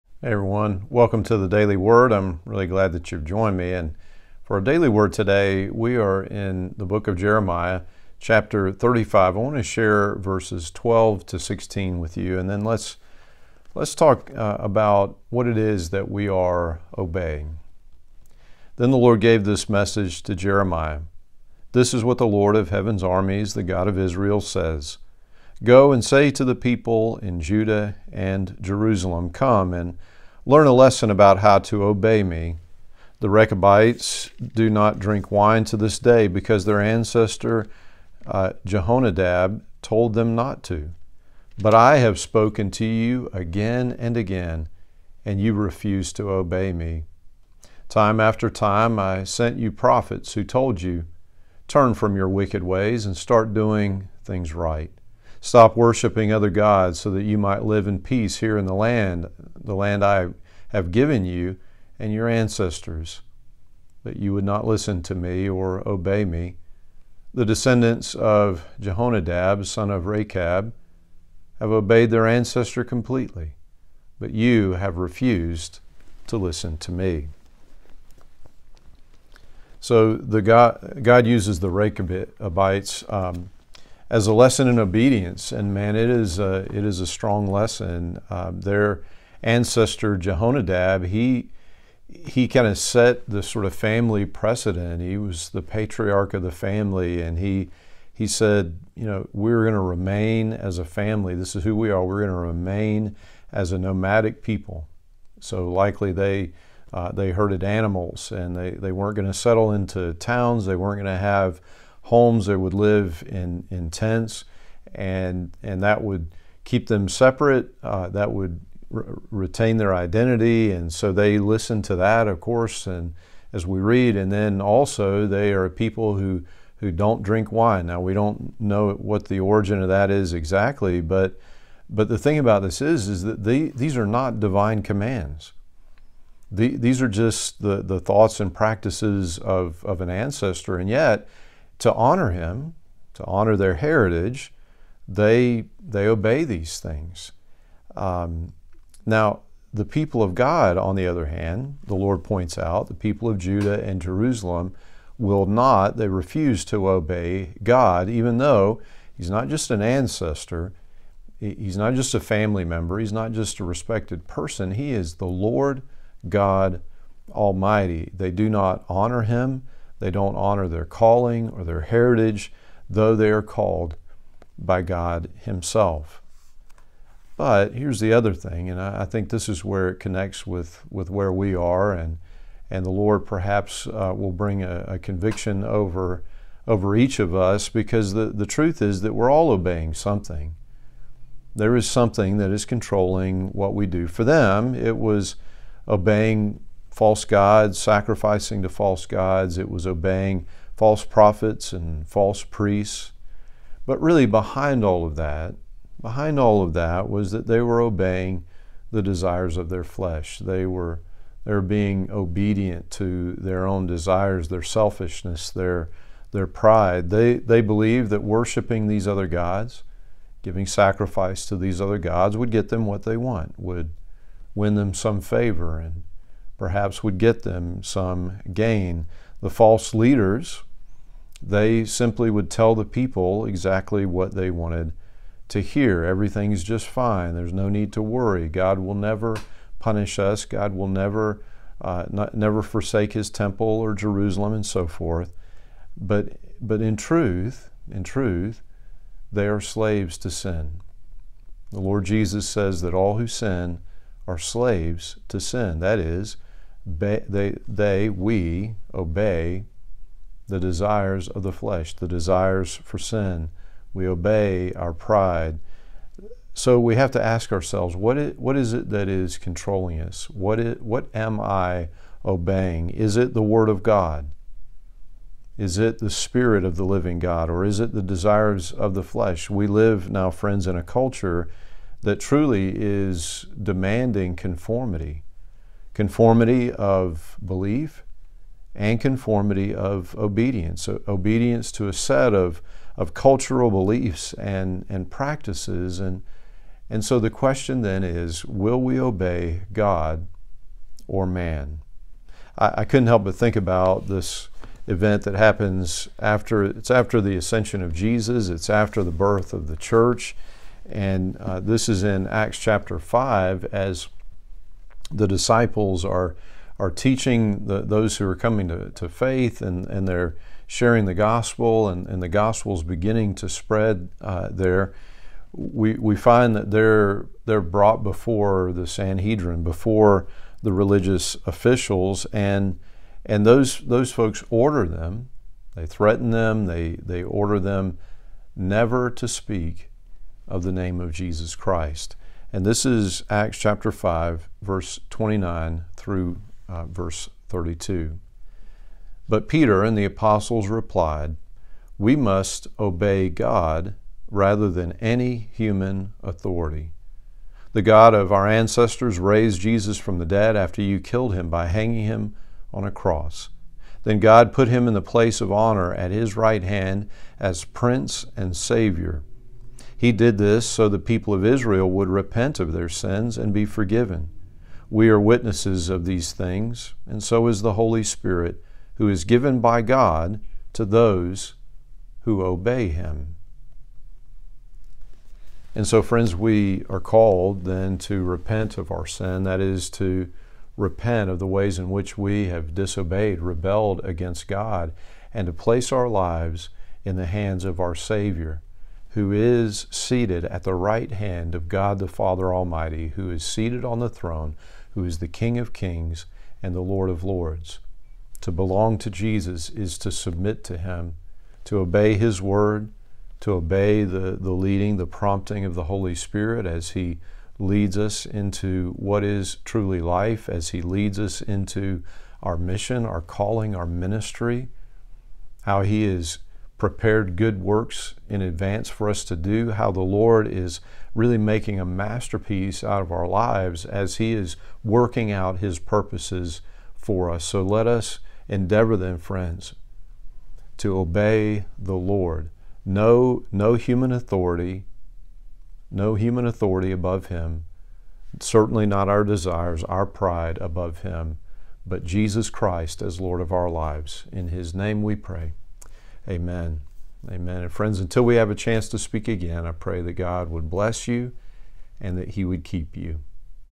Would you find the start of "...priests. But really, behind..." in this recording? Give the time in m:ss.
3:22.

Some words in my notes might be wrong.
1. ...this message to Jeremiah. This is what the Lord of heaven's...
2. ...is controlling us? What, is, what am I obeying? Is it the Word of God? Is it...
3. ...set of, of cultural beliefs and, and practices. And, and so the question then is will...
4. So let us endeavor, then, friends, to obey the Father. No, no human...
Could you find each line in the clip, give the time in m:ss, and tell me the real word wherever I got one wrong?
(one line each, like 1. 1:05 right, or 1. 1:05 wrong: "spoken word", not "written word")
1. 0:19 right
2. 4:29 right
3. 4:51 right
4. 7:17 wrong: "Lord", not "Father".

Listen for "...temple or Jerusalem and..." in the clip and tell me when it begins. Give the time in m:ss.
4:03.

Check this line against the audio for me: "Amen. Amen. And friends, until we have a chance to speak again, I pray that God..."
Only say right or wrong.
right.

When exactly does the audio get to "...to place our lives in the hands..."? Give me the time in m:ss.
6:35.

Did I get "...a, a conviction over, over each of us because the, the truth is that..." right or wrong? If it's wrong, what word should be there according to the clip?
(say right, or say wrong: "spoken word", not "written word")
right.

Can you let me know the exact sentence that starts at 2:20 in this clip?
And yet, to honor him, to honor their heritage, they, they obey these things.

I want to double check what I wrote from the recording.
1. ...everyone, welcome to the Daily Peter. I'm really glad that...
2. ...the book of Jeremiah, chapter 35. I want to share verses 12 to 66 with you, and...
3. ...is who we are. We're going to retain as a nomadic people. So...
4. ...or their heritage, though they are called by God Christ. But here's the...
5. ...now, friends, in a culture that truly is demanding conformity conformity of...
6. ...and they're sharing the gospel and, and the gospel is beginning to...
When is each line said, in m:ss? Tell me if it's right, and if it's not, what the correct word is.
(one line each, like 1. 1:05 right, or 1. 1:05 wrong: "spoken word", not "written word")
1. 0:00 wrong: "Word", not "Peter"
2. 0:06 wrong: "16", not "66"
3. 1:41 wrong: "remain", not "retain"
4. 2:51 wrong: "Himself", not "Christ"
5. 4:40 right
6. 5:19 right.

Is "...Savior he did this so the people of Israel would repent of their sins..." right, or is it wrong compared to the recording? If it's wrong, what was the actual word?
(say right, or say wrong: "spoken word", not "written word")
right.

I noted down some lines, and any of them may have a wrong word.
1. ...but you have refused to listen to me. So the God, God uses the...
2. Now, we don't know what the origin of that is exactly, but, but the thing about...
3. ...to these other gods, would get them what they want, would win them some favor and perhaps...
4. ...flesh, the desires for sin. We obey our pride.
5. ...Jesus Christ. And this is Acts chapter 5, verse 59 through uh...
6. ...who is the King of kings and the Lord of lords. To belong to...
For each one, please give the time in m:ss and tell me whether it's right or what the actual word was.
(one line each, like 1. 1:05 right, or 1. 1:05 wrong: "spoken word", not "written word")
1. 1:14 right
2. 2:07 right
3. 3:41 right
4. 4:21 right
5. 5:41 wrong: "29", not "59"
6. 6:44 right.